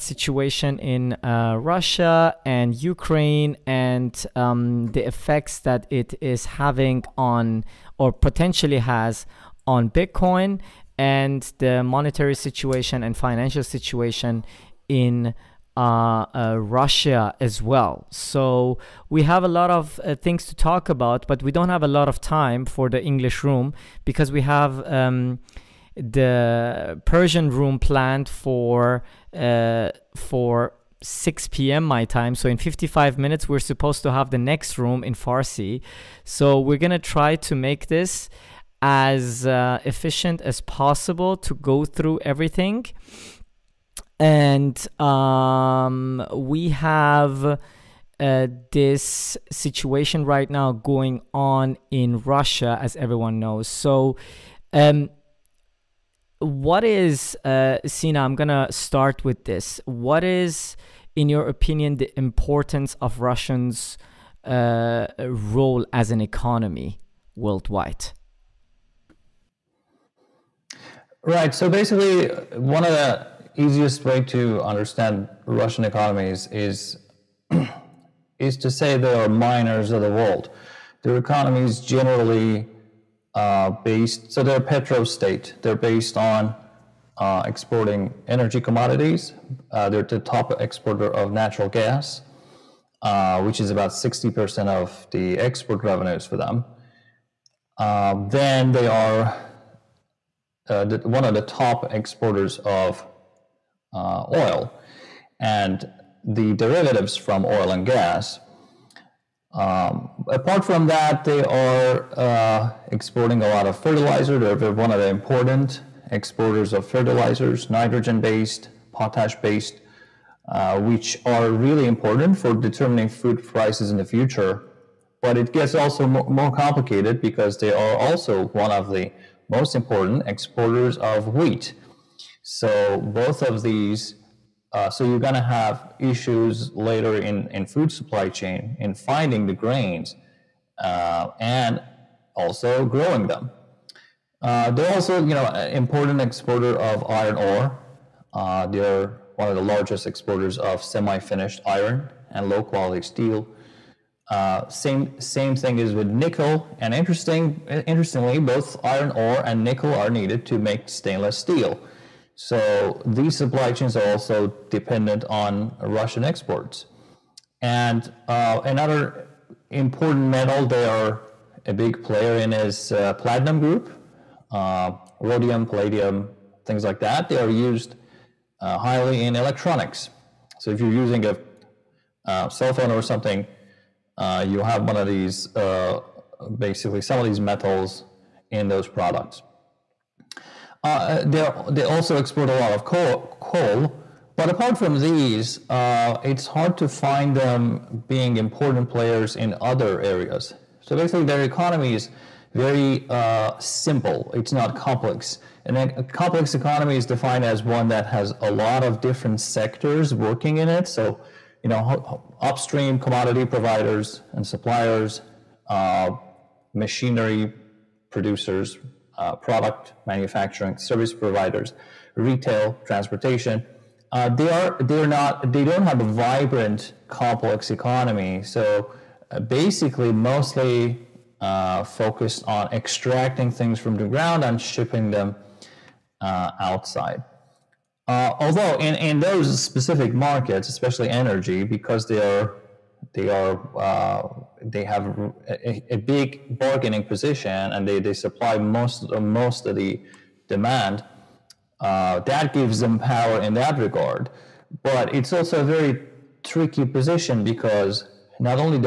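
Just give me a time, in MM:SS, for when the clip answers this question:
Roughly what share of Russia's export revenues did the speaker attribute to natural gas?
01:33.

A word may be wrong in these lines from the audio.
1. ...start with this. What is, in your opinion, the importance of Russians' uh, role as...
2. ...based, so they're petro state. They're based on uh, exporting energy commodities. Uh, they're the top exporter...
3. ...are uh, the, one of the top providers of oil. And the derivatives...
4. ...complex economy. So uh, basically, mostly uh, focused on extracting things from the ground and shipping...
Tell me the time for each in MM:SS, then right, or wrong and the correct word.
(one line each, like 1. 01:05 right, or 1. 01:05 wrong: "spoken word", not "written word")
1. 00:58 right
2. 01:23 right
3. 01:38 wrong: "exporters", not "providers"
4. 03:47 right.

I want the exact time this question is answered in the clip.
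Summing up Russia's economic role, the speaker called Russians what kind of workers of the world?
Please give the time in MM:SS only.
01:19.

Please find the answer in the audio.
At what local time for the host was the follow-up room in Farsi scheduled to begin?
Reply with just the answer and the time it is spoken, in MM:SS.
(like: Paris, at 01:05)
6 p.m., at 00:31.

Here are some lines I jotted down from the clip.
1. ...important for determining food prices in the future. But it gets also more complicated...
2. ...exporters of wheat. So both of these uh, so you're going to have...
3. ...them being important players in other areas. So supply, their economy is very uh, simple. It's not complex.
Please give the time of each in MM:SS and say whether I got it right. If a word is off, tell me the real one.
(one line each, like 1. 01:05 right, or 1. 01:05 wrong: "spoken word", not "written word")
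1. 02:01 right
2. 02:10 right
3. 03:17 wrong: "basically", not "supply".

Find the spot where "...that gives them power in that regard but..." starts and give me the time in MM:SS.
04:12.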